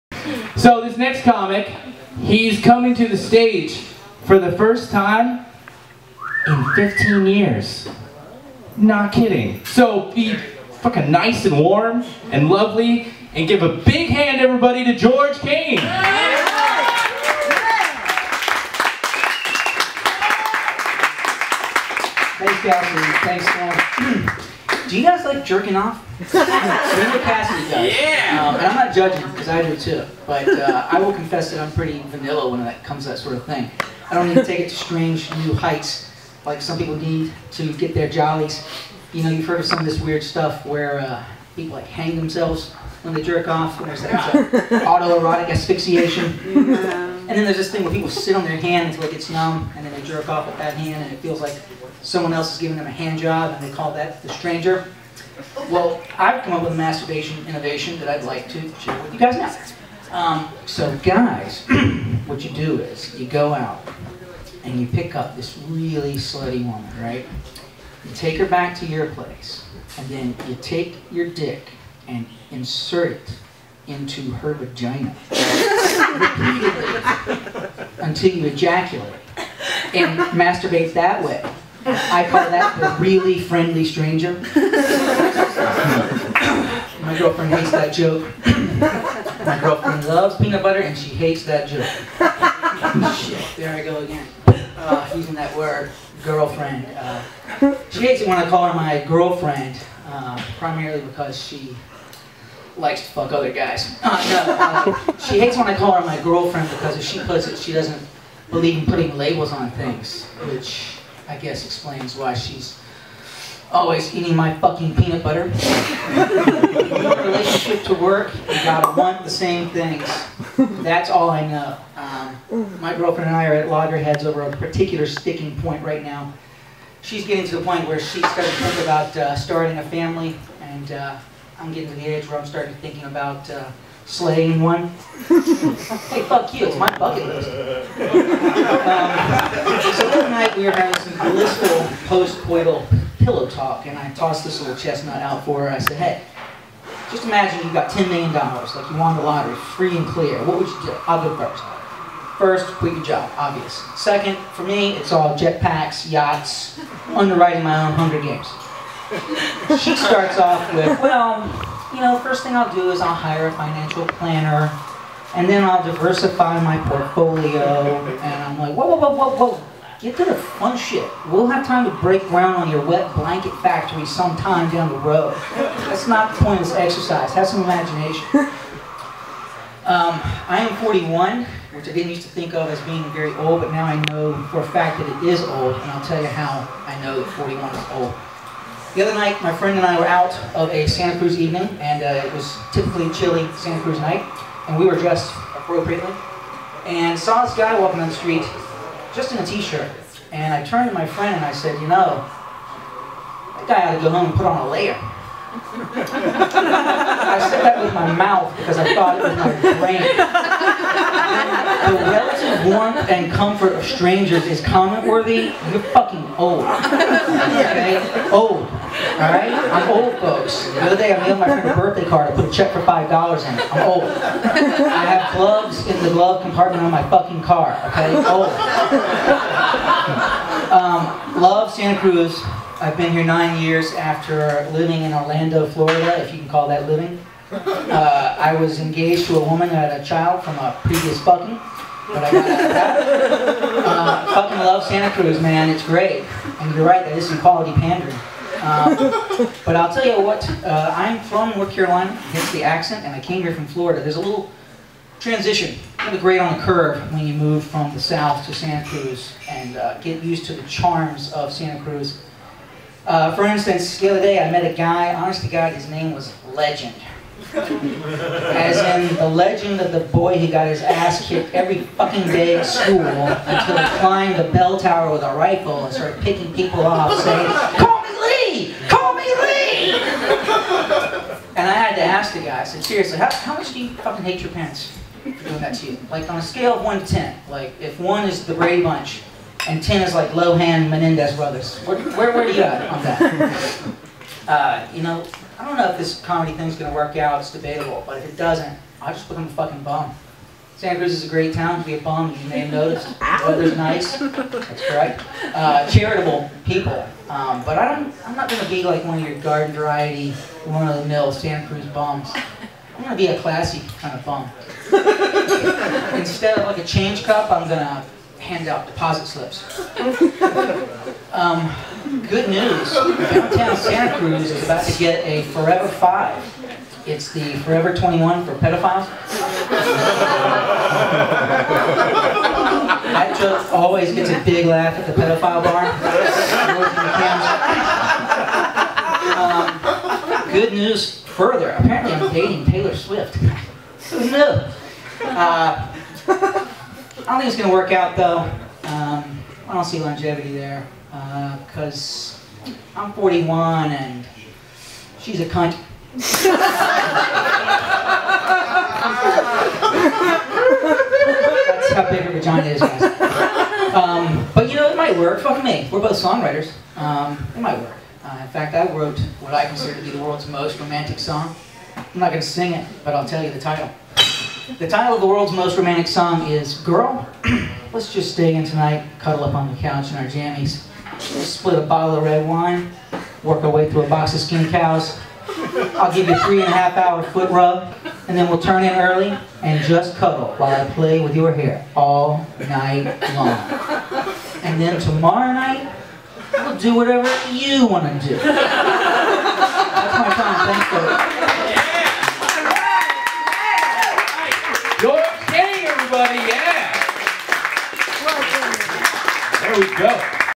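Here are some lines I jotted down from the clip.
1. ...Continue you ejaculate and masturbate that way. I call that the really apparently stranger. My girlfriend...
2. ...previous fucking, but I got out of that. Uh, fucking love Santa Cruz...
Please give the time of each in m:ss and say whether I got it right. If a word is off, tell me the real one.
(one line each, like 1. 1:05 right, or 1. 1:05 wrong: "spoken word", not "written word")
1. 1:18 wrong: "friendly", not "apparently"
2. 4:00 right.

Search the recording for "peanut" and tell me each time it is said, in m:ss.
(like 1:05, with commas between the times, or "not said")
1:30, 1:54.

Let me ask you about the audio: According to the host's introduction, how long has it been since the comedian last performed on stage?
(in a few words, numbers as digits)
15 years.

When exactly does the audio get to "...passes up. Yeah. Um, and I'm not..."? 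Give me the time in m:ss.
0:27.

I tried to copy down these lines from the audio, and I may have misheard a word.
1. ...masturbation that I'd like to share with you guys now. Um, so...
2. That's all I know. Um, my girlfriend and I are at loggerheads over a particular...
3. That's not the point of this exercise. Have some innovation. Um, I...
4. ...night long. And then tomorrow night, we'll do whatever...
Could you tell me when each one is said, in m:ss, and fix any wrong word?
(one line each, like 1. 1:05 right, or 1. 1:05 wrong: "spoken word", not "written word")
1. 0:57 wrong: "innovation", not "masturbation"
2. 2:00 right
3. 2:55 wrong: "imagination", not "innovation"
4. 6:32 right.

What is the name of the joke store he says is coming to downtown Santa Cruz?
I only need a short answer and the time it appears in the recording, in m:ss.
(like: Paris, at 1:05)
Forever 5, at 5:25.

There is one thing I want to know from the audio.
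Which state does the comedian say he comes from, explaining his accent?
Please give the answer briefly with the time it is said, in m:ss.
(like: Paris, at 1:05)
North Carolina, at 4:11.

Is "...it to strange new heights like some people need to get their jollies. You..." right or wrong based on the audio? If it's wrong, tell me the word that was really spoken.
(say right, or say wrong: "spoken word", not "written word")
right.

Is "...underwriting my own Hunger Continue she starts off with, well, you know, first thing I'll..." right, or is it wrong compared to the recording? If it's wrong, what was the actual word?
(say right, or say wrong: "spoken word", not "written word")
wrong: "Games", not "Continue".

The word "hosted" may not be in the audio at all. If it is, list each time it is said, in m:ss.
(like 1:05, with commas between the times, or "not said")
not said.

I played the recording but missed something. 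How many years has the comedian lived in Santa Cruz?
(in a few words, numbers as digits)
9.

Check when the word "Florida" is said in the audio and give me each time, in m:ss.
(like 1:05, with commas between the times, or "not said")
3:55, 4:13.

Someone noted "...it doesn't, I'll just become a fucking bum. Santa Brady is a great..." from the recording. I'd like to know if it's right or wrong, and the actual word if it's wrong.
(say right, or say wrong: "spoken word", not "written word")
wrong: "Cruz", not "Brady".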